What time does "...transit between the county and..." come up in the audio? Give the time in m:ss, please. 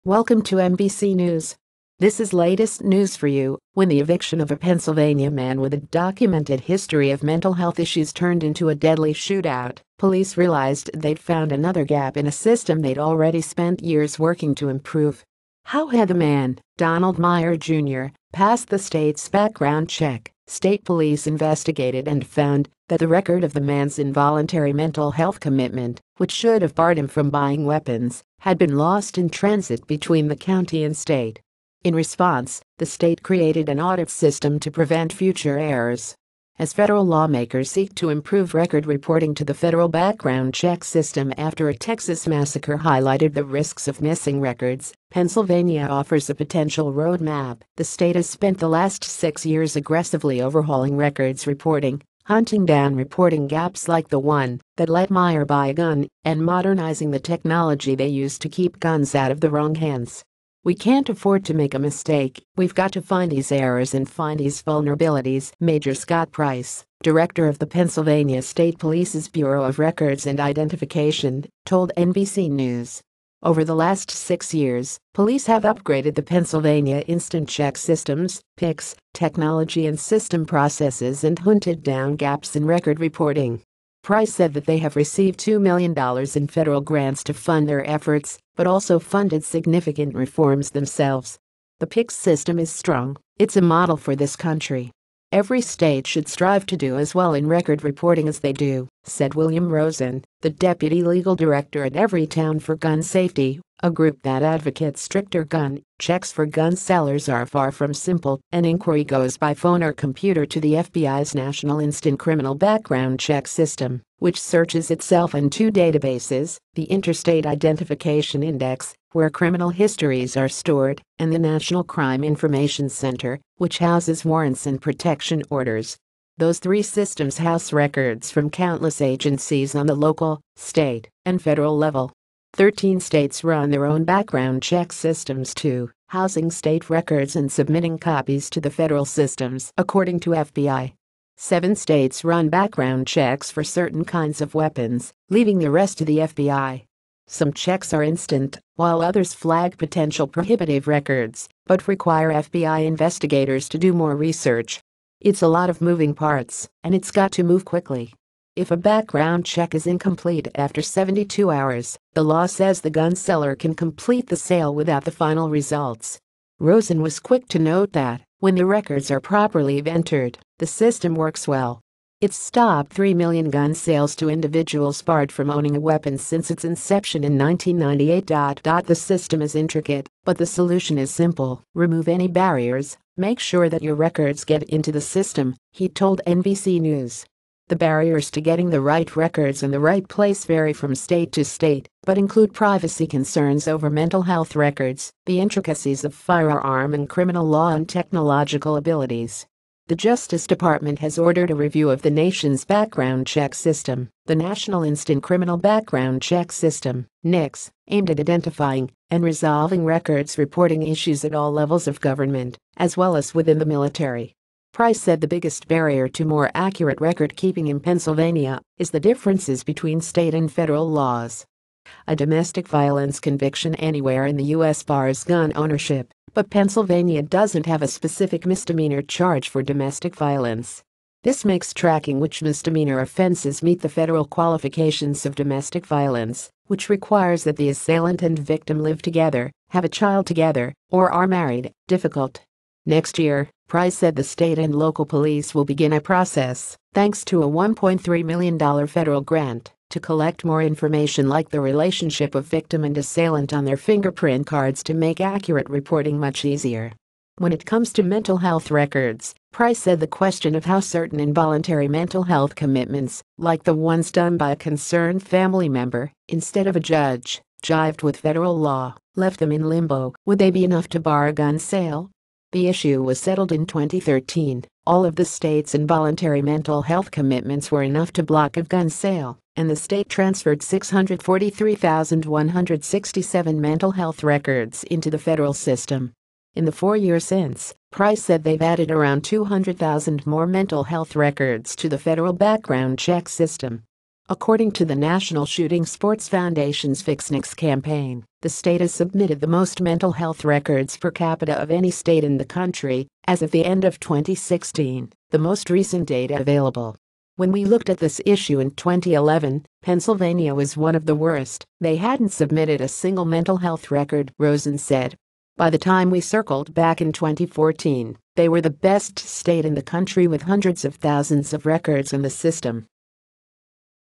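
0:29.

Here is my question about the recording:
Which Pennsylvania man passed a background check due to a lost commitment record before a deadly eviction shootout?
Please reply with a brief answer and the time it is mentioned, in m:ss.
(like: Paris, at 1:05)
Donald Meyer Jr., at 0:16.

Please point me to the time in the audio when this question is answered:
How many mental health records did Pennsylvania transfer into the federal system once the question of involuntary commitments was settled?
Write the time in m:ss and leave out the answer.
4:40.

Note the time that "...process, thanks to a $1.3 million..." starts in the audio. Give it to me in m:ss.
4:06.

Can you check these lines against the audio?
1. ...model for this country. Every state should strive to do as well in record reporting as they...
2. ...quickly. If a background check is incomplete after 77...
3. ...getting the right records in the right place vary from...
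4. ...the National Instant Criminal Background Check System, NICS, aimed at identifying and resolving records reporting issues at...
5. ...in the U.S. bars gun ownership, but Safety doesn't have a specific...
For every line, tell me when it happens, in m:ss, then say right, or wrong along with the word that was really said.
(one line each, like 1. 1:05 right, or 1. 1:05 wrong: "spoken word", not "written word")
1. 1:33 right
2. 2:37 wrong: "72", not "77"
3. 3:08 right
4. 3:24 right
5. 3:44 wrong: "Pennsylvania", not "Safety".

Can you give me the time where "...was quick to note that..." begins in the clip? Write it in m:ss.
2:47.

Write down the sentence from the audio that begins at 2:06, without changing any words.
Those three systems house records from countless agencies on the local, state, and federal level.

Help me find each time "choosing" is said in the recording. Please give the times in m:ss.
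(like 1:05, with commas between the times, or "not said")
not said.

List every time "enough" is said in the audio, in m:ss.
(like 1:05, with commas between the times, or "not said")
4:30, 4:37.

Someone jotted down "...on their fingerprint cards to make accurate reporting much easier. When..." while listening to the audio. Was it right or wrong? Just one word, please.
right.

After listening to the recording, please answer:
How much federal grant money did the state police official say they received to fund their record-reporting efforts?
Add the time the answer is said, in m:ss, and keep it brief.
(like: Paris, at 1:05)
$2 million, at 1:25.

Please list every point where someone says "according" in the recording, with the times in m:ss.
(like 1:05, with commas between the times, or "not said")
2:19, 4:54.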